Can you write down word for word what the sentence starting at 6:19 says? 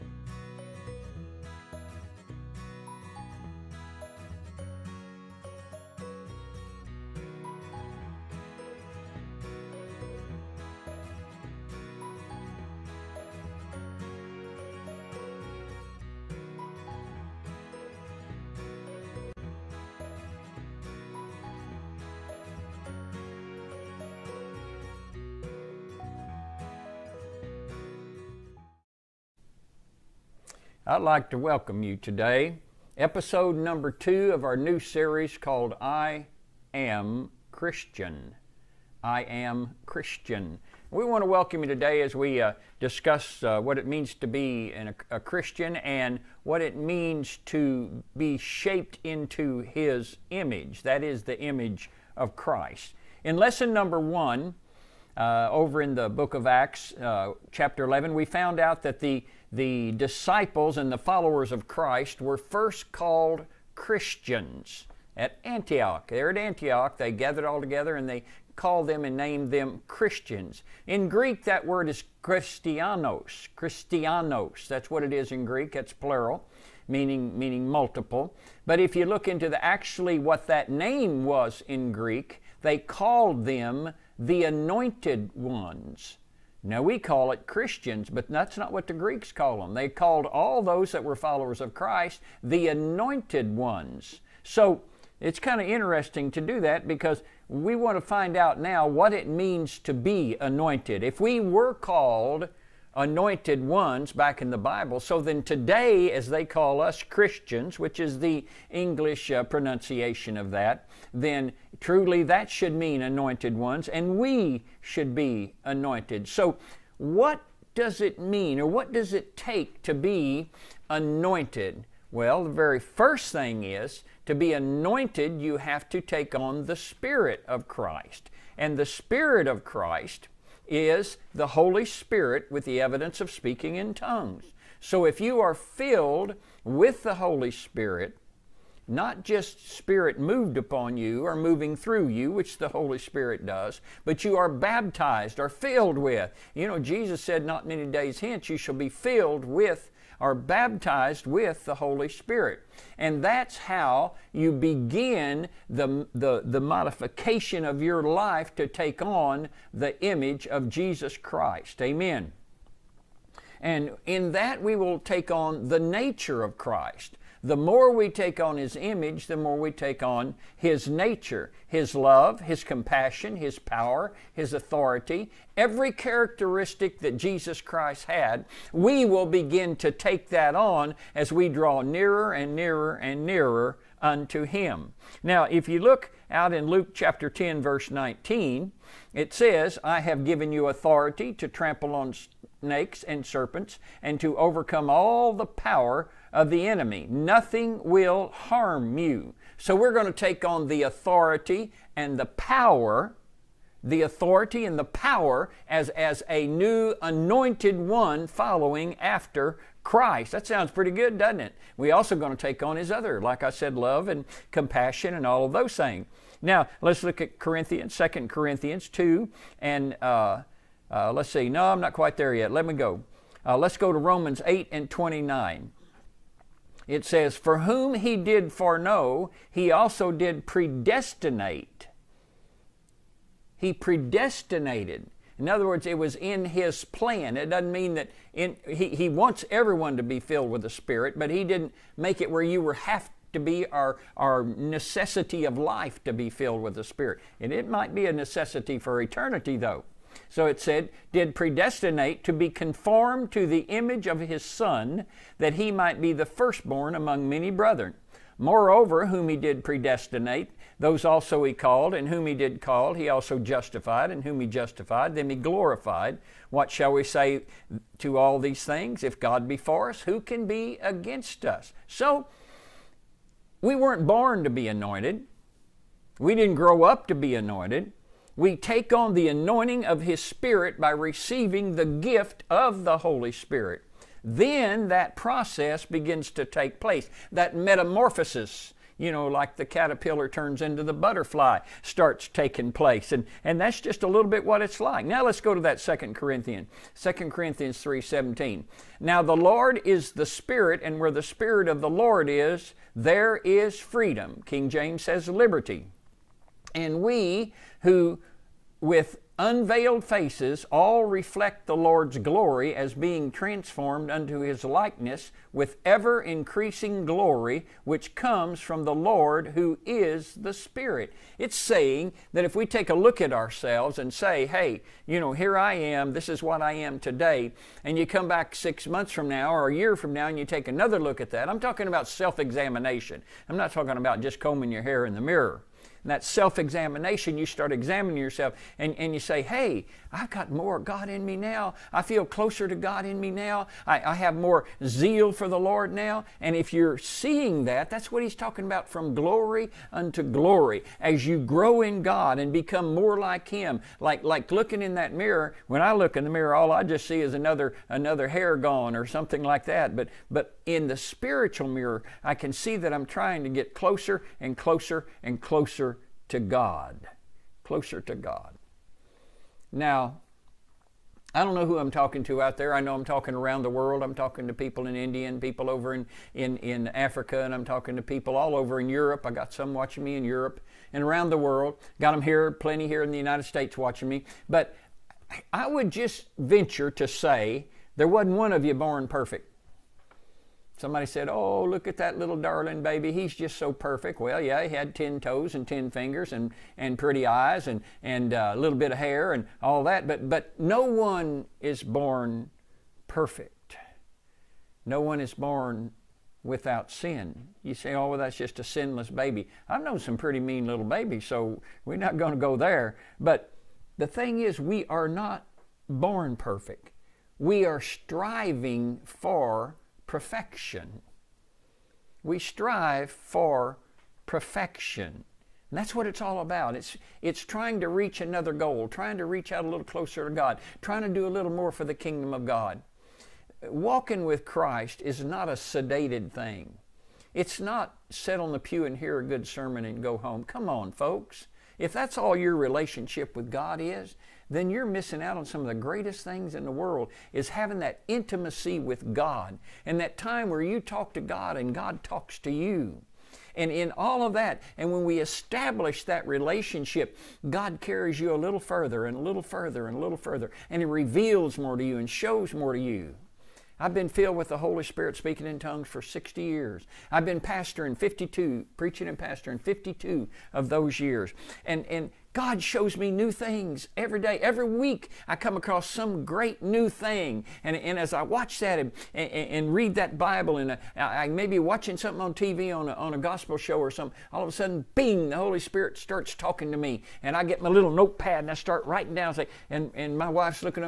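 I got some watching me in Europe and around the world.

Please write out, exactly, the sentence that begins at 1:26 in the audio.
Now, we call it Christians, but that's not what the Greeks called them.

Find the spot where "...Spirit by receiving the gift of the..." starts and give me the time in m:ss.
4:40.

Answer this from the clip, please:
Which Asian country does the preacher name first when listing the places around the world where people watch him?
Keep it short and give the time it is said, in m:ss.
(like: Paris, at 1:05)
India, at 6:14.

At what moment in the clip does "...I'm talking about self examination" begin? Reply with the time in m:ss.
5:31.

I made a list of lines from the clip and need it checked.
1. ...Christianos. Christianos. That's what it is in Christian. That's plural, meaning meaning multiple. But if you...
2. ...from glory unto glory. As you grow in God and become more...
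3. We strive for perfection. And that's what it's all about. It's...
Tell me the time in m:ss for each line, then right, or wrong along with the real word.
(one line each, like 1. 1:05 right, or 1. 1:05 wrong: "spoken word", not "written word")
1. 1:12 wrong: "Greek", not "Christian"
2. 5:48 right
3. 7:02 right.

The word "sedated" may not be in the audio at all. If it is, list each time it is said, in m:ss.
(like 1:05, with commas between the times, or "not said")
7:15.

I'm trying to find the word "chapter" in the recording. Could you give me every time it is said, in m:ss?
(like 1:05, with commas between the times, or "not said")
0:57, 3:06.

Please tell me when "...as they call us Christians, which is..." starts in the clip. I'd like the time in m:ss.
1:46.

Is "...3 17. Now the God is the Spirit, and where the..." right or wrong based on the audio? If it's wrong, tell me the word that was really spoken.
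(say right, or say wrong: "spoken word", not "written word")
wrong: "Lord", not "God".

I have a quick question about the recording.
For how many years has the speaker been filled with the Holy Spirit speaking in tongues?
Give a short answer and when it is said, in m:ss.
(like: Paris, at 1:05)
60, at 7:46.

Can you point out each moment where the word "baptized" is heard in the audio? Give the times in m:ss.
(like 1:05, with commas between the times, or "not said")
2:24, 2:30.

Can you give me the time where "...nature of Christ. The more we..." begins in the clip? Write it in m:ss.
2:45.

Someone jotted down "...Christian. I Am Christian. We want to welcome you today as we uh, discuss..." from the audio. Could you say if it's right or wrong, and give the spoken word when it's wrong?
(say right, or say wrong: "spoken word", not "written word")
right.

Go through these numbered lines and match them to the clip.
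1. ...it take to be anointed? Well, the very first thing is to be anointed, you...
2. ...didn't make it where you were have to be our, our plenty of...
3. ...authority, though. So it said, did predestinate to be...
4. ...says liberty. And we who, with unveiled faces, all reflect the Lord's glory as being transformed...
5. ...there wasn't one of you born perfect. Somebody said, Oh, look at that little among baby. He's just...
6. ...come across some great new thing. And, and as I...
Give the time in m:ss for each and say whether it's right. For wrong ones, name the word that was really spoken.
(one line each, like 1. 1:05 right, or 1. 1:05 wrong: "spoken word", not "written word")
1. 1:59 right
2. 4:01 wrong: "necessity", not "plenty"
3. 4:09 wrong: "eternity", not "authority"
4. 5:05 right
5. 6:27 wrong: "darling", not "among"
6. 7:55 right.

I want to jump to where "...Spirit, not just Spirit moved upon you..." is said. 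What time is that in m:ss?
2:17.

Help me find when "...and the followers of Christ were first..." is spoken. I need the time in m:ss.
1:00.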